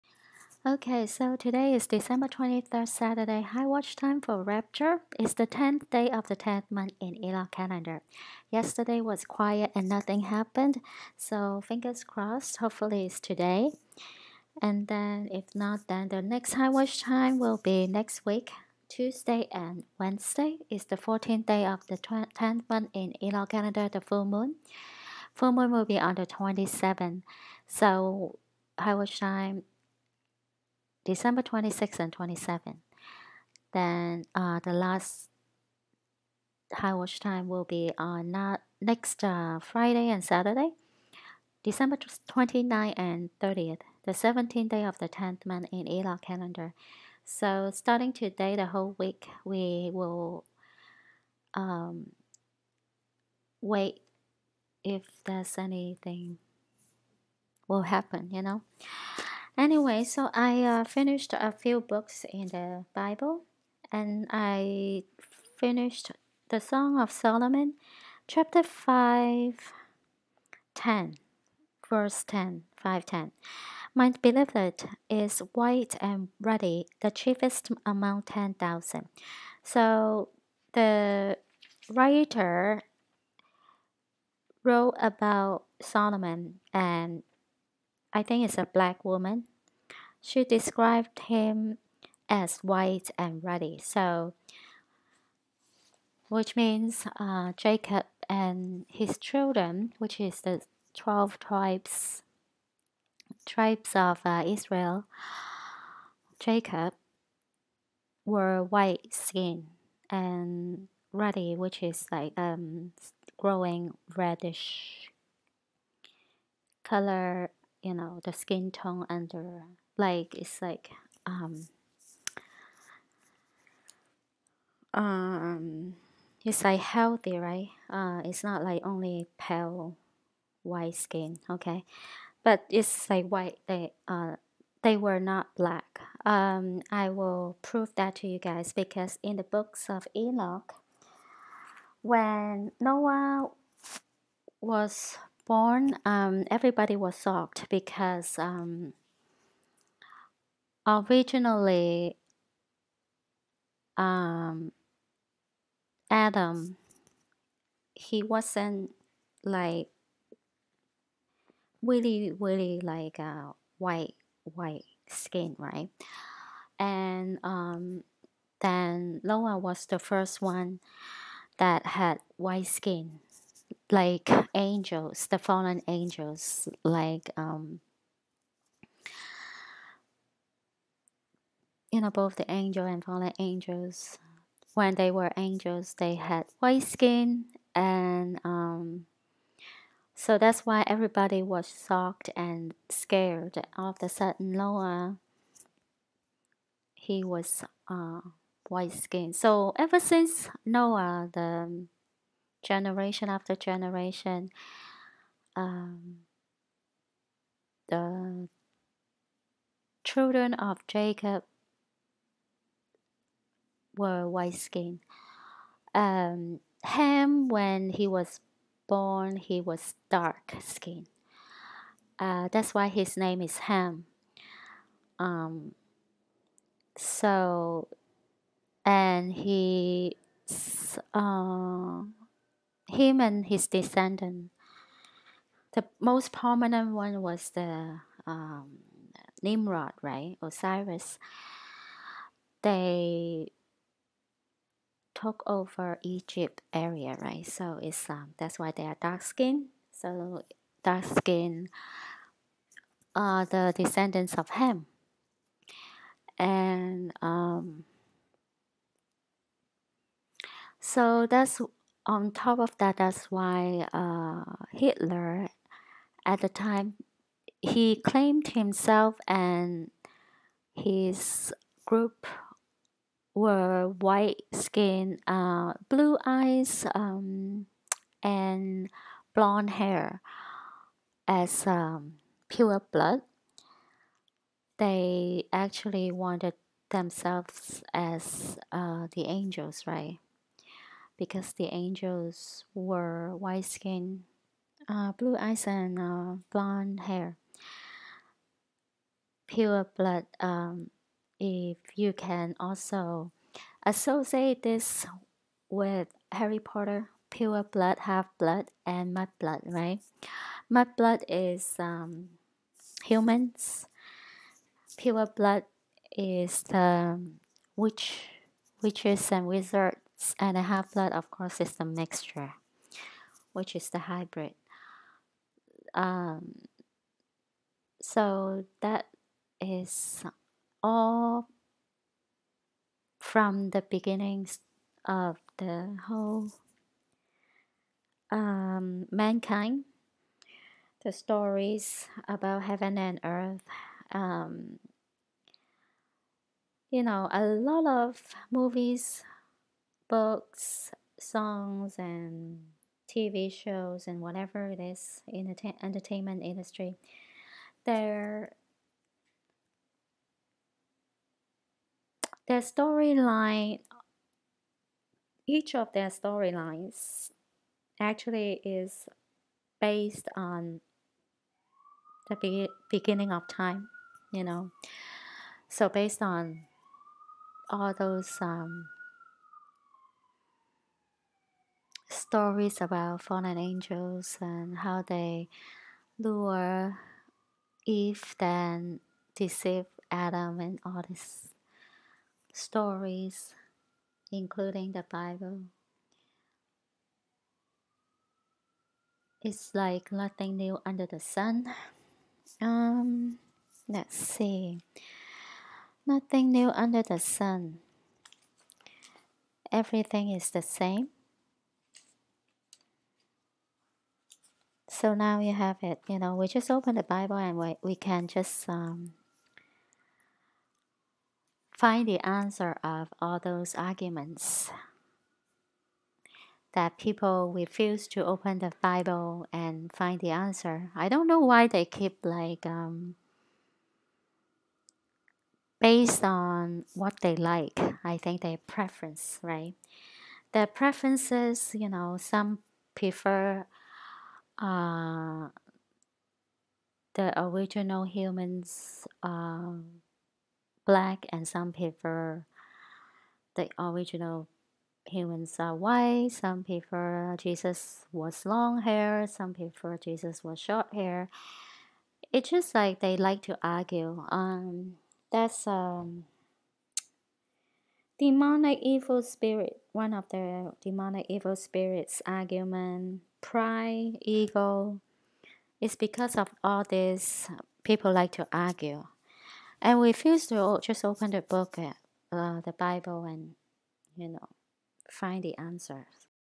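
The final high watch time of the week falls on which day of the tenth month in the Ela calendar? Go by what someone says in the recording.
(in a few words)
17th.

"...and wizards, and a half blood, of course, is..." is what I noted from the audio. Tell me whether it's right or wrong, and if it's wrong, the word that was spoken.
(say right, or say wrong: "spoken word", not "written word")
right.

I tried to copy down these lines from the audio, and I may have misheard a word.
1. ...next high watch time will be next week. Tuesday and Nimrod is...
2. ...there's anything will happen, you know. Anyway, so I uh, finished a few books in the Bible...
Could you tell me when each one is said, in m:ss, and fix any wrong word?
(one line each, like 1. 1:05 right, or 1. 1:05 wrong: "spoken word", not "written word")
1. 0:16 wrong: "Wednesday", not "Nimrod"
2. 0:55 right.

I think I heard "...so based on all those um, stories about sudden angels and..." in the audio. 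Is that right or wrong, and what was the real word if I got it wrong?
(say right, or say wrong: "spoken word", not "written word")
wrong: "fallen", not "sudden".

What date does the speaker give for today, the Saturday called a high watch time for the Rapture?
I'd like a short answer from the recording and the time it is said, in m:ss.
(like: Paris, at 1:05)
December 23, at 0:01.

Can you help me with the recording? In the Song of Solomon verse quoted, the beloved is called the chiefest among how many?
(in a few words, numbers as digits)
10,000.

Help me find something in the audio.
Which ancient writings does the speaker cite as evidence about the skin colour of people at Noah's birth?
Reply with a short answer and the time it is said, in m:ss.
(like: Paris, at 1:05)
Books of Enoch, at 2:19.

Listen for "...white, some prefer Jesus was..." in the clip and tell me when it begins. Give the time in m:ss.
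7:35.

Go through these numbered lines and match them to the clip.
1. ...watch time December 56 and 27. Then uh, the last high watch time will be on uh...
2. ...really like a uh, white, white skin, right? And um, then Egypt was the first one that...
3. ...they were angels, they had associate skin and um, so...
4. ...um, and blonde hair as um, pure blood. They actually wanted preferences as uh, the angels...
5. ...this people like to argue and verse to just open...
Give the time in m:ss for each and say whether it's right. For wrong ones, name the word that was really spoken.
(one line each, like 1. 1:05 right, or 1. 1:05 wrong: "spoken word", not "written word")
1. 0:28 wrong: "26", not "56"
2. 2:42 wrong: "Noah", not "Egypt"
3. 3:04 wrong: "white", not "associate"
4. 4:36 wrong: "themselves", not "preferences"
5. 7:56 wrong: "refuse", not "verse".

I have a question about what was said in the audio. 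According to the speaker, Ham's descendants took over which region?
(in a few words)
Egypt.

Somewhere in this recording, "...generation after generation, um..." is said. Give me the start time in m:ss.
3:22.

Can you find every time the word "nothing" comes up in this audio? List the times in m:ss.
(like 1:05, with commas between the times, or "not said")
0:09, 6:40, 6:46.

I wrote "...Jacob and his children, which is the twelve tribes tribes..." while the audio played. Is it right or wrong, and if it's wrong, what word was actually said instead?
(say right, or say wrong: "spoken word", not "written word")
right.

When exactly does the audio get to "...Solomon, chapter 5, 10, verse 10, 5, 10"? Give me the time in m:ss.
1:07.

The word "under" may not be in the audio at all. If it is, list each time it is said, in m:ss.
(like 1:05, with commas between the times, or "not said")
1:59, 6:40, 6:46.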